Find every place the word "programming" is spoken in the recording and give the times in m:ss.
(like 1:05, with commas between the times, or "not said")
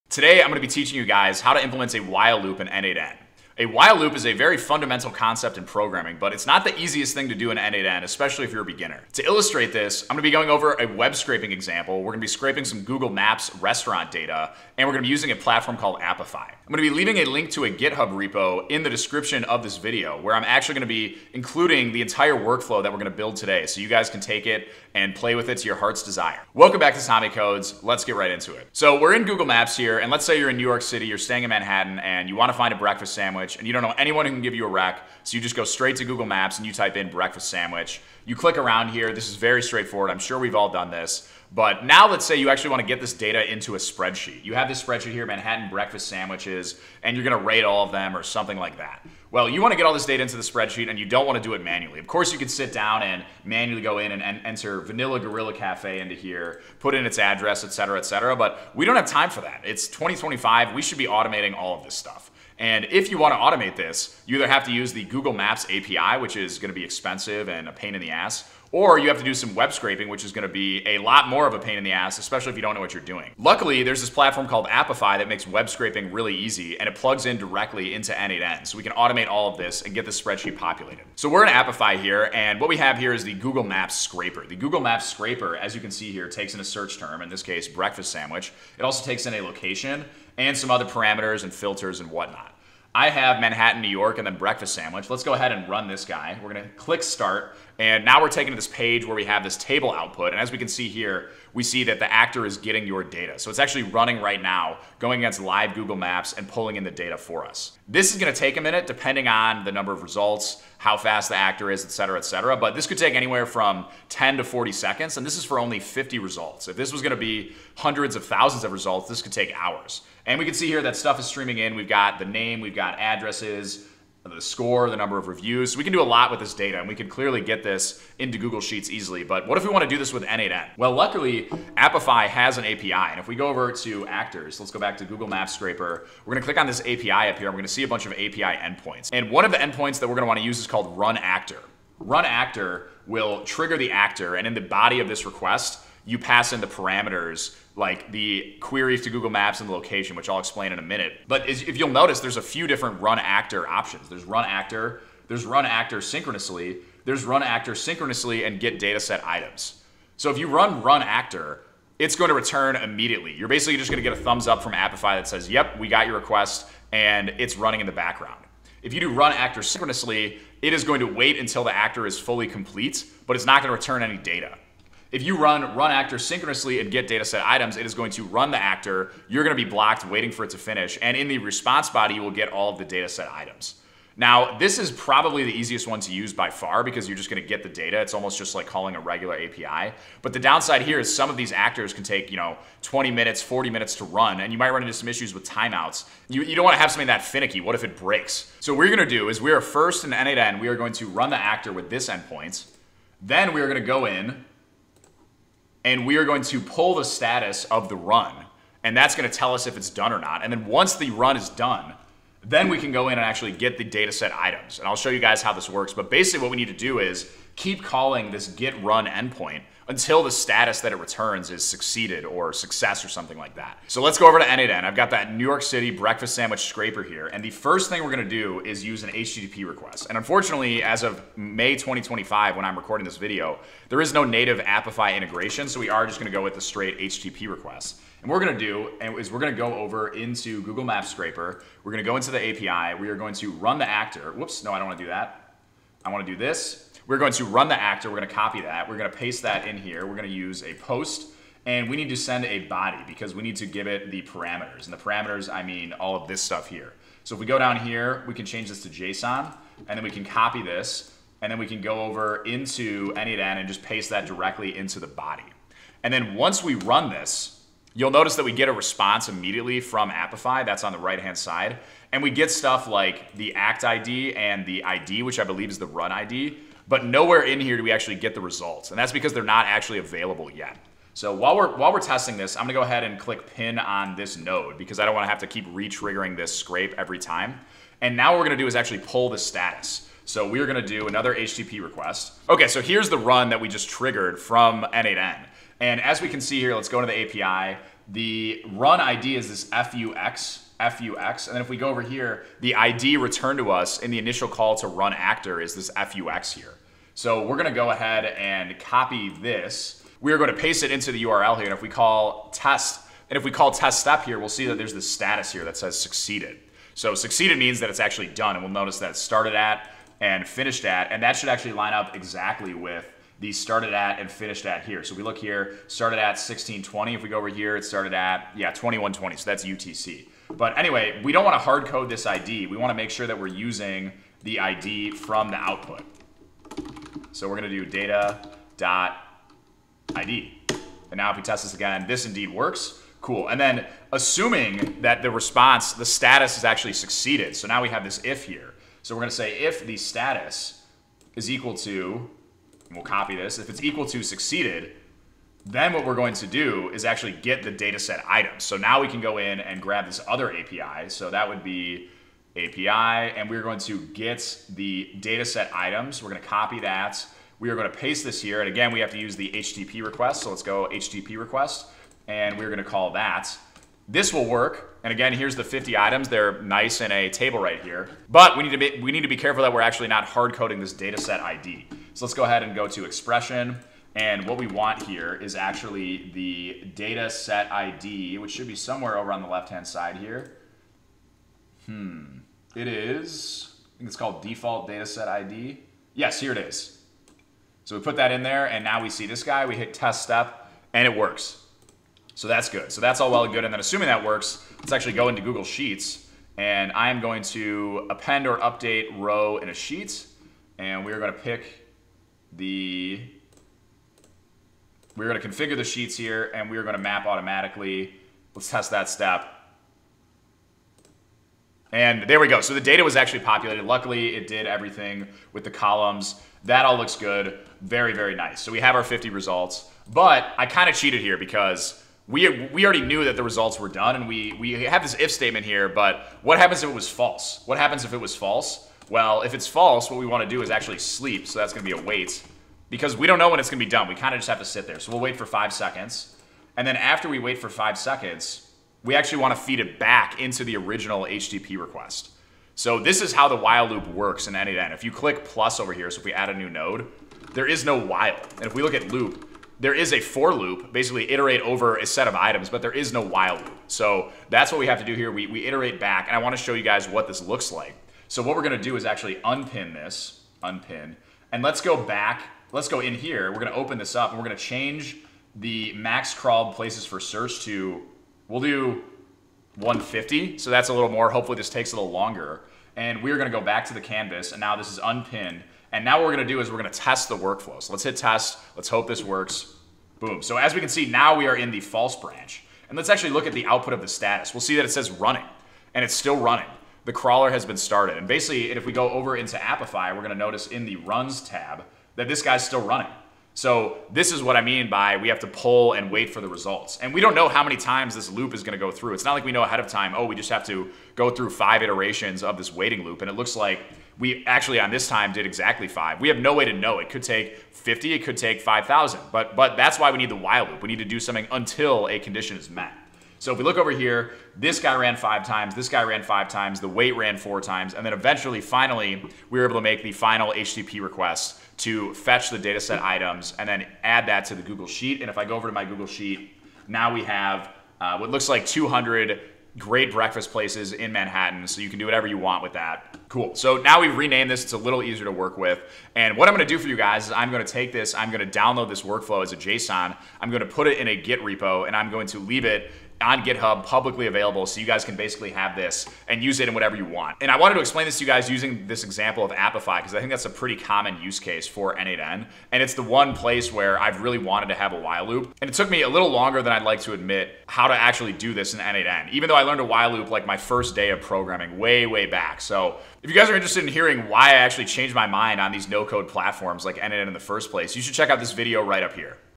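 0:05, 9:31.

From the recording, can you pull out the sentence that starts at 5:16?
So succeeded means that it's actually done.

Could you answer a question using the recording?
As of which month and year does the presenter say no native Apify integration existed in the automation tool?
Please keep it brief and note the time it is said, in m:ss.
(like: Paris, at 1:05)
May 2025, at 3:51.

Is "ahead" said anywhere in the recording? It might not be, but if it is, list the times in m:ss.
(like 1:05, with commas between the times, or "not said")
1:35, 4:42, 5:07, 6:22, 8:29.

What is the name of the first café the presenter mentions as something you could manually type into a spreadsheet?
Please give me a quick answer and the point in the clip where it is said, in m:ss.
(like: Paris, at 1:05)
Vanilla Gorilla Cafe, at 0:54.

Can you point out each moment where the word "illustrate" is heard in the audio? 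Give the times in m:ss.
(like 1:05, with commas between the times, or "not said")
0:09.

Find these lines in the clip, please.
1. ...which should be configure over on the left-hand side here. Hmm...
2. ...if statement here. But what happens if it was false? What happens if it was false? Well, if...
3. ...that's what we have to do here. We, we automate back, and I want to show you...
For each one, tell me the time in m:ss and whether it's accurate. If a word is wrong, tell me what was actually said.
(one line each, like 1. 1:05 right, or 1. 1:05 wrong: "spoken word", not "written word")
1. 6:28 wrong: "somewhere", not "configure"
2. 7:15 right
3. 7:44 wrong: "iterate", not "automate".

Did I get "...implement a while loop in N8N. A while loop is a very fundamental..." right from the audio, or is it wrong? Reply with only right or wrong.
right.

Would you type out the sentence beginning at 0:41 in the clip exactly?
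But now let's say you actually want to get this data into a spreadsheet.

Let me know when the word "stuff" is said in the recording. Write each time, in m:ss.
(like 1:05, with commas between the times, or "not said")
1:01, 2:00, 4:16, 4:32.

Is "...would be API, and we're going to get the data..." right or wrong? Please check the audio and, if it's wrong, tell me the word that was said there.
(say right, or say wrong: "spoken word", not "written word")
right.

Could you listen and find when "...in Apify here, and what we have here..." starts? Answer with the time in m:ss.
1:21.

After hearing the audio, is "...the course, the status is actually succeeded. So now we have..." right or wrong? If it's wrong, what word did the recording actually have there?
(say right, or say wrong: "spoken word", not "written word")
wrong: "response", not "course".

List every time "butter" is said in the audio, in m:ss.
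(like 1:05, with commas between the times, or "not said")
not said.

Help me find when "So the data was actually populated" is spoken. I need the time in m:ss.
7:02.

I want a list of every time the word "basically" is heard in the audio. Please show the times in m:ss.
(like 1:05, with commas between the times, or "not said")
2:43, 3:36, 7:40, 8:18, 9:15.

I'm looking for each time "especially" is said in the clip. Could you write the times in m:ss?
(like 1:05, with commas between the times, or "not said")
0:08, 1:12.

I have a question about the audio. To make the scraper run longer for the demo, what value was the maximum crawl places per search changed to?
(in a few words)
150.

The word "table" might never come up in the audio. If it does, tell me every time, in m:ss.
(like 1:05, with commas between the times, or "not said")
1:39, 6:17.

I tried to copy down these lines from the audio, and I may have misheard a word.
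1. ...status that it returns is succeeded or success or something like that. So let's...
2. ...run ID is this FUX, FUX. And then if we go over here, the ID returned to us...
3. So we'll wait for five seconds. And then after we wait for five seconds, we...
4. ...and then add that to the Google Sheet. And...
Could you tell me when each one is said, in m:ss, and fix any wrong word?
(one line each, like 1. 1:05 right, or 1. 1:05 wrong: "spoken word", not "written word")
1. 3:40 right
2. 4:58 right
3. 7:25 right
4. 8:53 right.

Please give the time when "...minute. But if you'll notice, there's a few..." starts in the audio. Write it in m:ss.
2:30.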